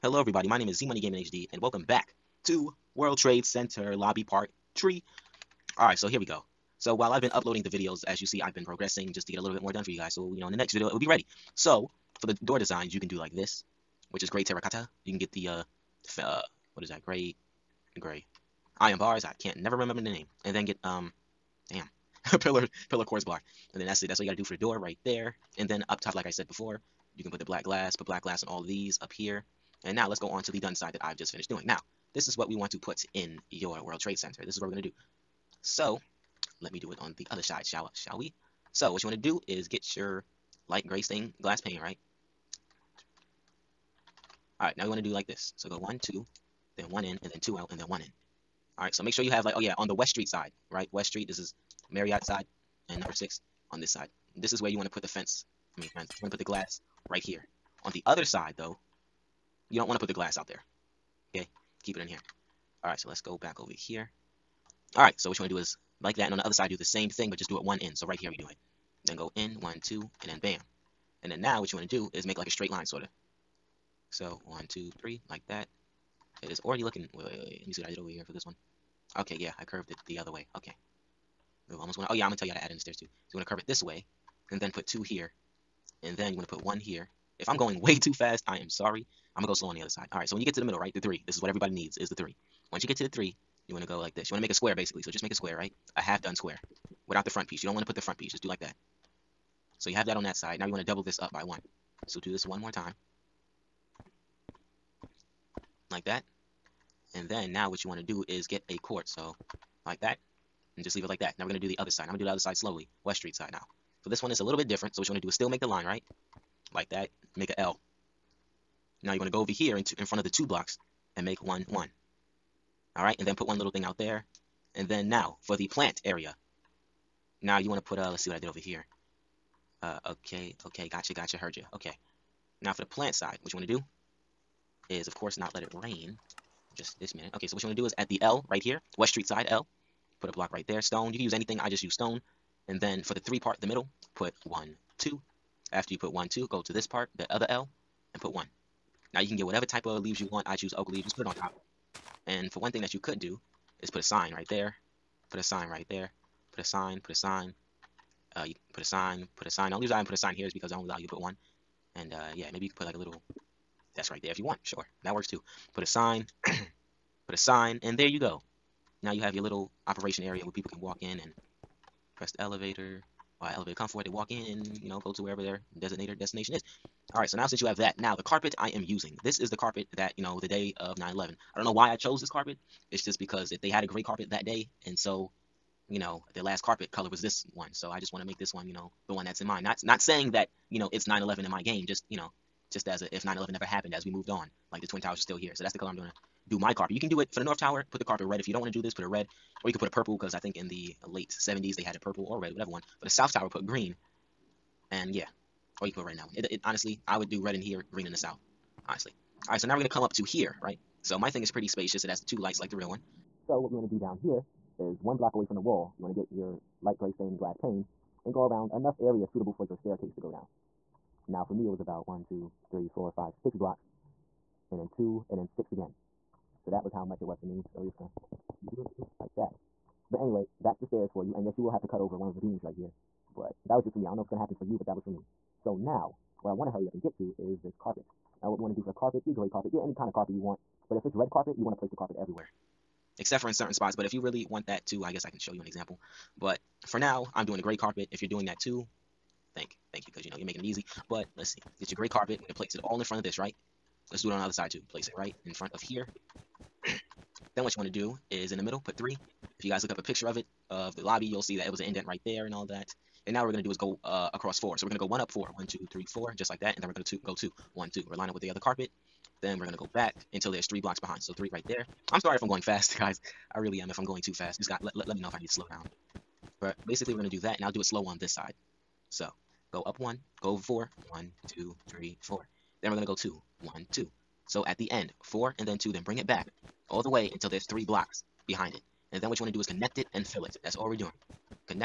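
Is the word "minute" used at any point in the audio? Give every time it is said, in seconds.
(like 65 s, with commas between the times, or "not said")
137 s.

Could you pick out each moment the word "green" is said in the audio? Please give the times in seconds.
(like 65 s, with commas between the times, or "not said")
203 s, 207 s.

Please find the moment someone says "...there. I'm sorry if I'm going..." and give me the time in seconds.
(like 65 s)
271 s.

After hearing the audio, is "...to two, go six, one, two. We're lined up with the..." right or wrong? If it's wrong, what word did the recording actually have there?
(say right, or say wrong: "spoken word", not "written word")
wrong: "two", not "six".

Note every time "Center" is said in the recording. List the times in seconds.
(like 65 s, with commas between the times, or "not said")
3 s, 34 s.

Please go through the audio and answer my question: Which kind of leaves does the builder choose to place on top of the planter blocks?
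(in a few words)
Oak leaves.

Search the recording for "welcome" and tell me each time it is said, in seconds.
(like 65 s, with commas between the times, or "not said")
1 s.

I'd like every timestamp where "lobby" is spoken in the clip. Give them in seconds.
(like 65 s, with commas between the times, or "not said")
3 s, 261 s.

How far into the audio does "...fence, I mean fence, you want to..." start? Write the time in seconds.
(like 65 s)
55 s.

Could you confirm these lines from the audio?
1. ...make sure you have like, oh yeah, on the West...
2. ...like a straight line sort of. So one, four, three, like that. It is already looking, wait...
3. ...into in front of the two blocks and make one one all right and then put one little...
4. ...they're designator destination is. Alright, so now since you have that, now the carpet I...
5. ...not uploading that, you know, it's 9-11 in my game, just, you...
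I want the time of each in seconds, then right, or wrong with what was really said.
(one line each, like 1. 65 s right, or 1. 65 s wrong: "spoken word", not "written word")
1. 49 s right
2. 72 s wrong: "two", not "four"
3. 119 s right
4. 175 s right
5. 189 s wrong: "saying", not "uploading".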